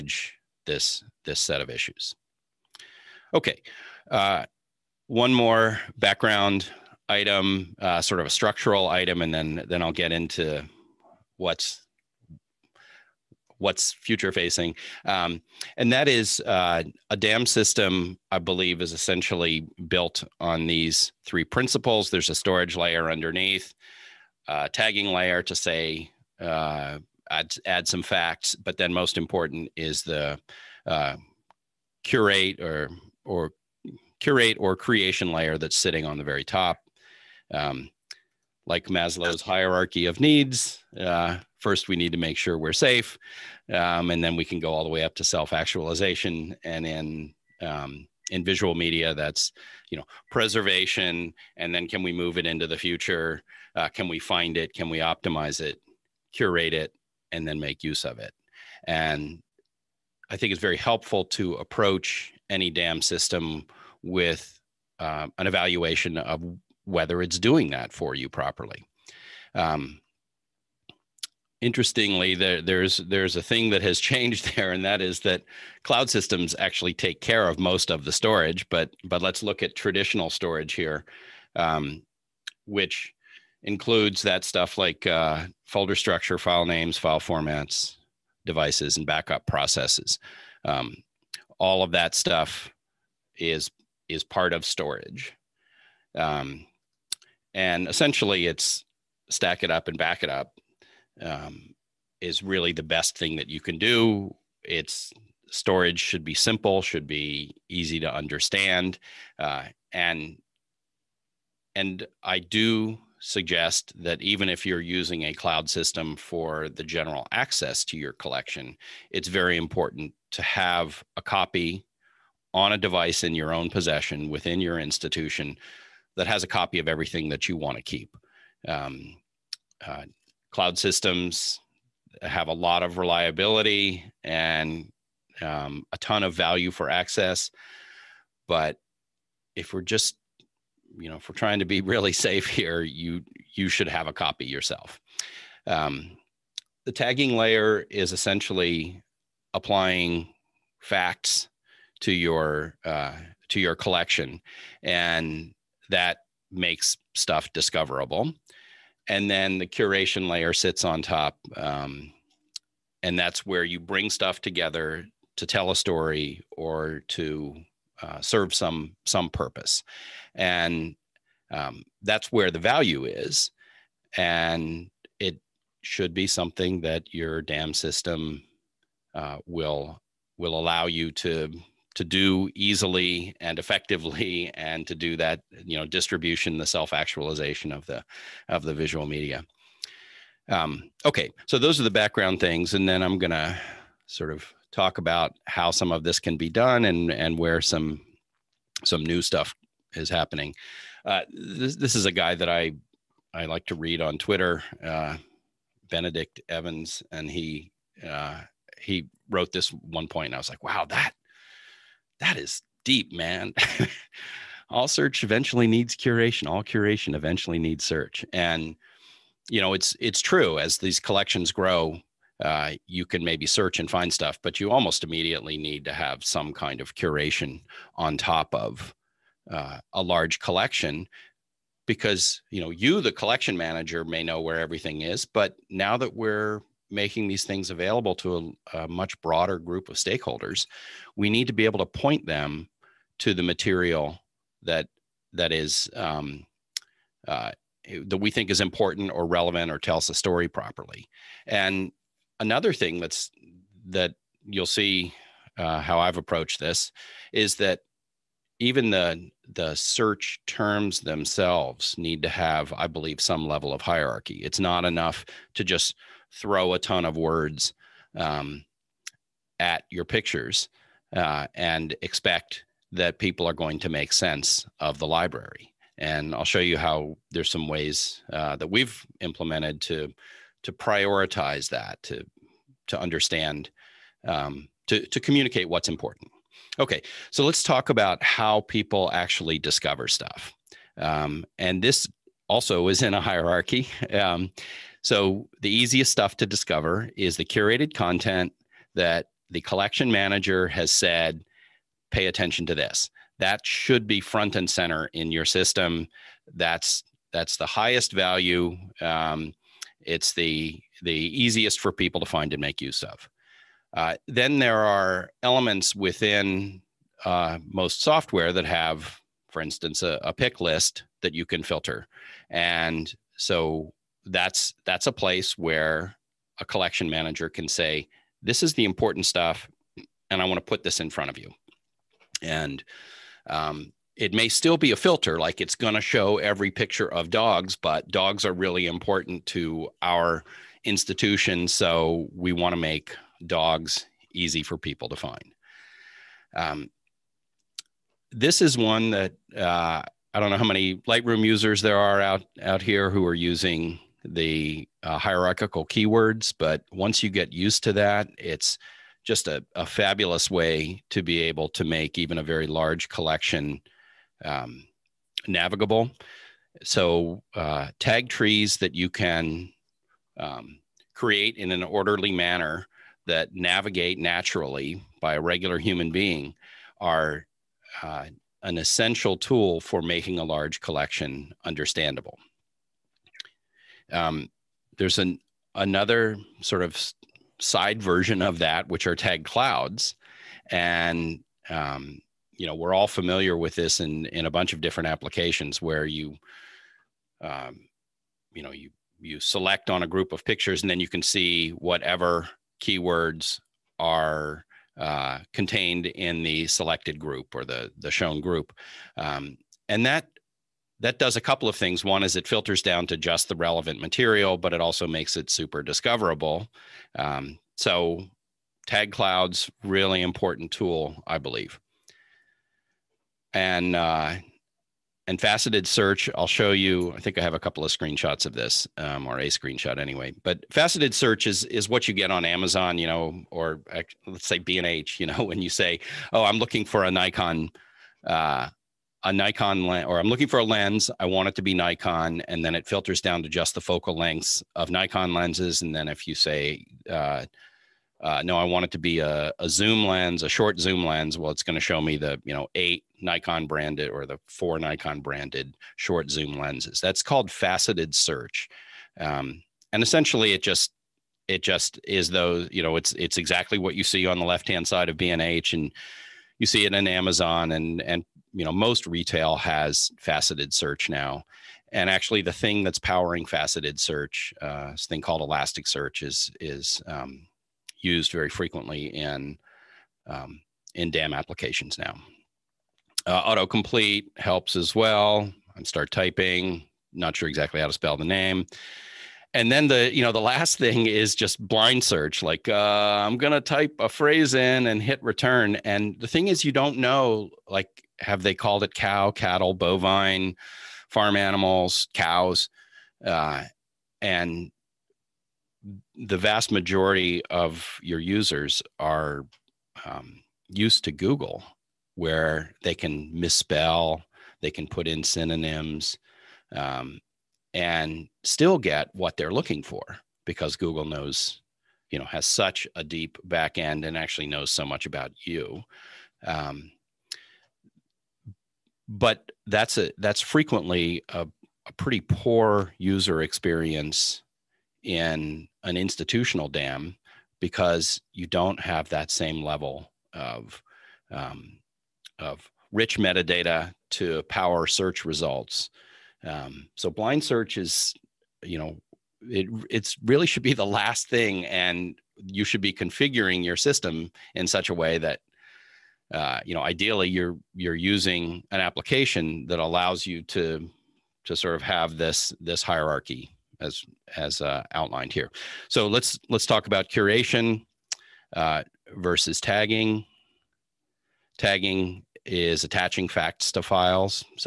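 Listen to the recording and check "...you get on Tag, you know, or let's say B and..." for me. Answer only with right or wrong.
wrong.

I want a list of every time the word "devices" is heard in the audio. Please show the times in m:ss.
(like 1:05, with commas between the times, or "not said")
1:28, 2:02.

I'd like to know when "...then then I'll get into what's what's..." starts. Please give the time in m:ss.
0:09.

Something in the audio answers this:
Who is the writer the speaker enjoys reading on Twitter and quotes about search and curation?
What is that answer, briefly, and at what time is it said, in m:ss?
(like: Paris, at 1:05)
Benedict Evans, at 3:25.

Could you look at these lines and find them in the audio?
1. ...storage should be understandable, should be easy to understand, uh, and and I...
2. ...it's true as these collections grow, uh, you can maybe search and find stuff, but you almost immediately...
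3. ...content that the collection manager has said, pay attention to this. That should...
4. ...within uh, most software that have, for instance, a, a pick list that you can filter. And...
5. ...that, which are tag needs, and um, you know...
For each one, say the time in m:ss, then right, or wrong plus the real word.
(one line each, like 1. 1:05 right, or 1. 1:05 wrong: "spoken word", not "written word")
1. 1:45 wrong: "simple", not "understandable"
2. 3:39 right
3. 4:57 right
4. 5:15 right
5. 6:28 wrong: "clouds", not "needs".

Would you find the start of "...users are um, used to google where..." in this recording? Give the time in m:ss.
8:28.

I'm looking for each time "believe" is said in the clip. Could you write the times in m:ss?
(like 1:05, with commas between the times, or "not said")
0:18, 4:22, 7:01.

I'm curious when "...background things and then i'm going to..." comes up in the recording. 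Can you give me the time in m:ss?
3:11.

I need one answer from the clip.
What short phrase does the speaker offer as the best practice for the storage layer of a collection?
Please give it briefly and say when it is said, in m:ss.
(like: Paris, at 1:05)
stack it up and back it up, at 1:39.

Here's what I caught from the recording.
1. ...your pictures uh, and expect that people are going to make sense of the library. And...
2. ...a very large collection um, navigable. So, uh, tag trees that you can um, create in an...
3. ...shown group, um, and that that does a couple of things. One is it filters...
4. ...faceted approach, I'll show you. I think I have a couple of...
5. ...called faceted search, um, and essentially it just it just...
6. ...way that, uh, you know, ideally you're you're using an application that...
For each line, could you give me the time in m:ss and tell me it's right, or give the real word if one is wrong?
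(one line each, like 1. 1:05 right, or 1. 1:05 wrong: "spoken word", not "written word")
1. 4:29 right
2. 6:02 right
3. 6:48 right
4. 7:05 wrong: "search", not "approach"
5. 7:37 right
6. 9:14 right.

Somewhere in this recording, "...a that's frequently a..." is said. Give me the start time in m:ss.
8:49.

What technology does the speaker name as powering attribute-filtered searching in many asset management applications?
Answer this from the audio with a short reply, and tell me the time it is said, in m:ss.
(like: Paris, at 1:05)
Elasticsearch, at 7:55.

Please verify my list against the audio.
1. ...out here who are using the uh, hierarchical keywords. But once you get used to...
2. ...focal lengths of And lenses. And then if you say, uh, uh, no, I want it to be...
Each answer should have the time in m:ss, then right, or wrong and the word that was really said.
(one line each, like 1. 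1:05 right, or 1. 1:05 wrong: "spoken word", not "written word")
1. 5:52 right
2. 7:23 wrong: "Nikon", not "And".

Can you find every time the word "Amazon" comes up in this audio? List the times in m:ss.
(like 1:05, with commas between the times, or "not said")
7:12, 7:47.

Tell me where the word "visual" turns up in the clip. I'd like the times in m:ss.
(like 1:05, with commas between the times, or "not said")
0:48, 3:08.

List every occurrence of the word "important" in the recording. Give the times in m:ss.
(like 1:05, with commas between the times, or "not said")
0:29, 1:59, 4:08, 4:45, 5:28, 5:38, 7:00.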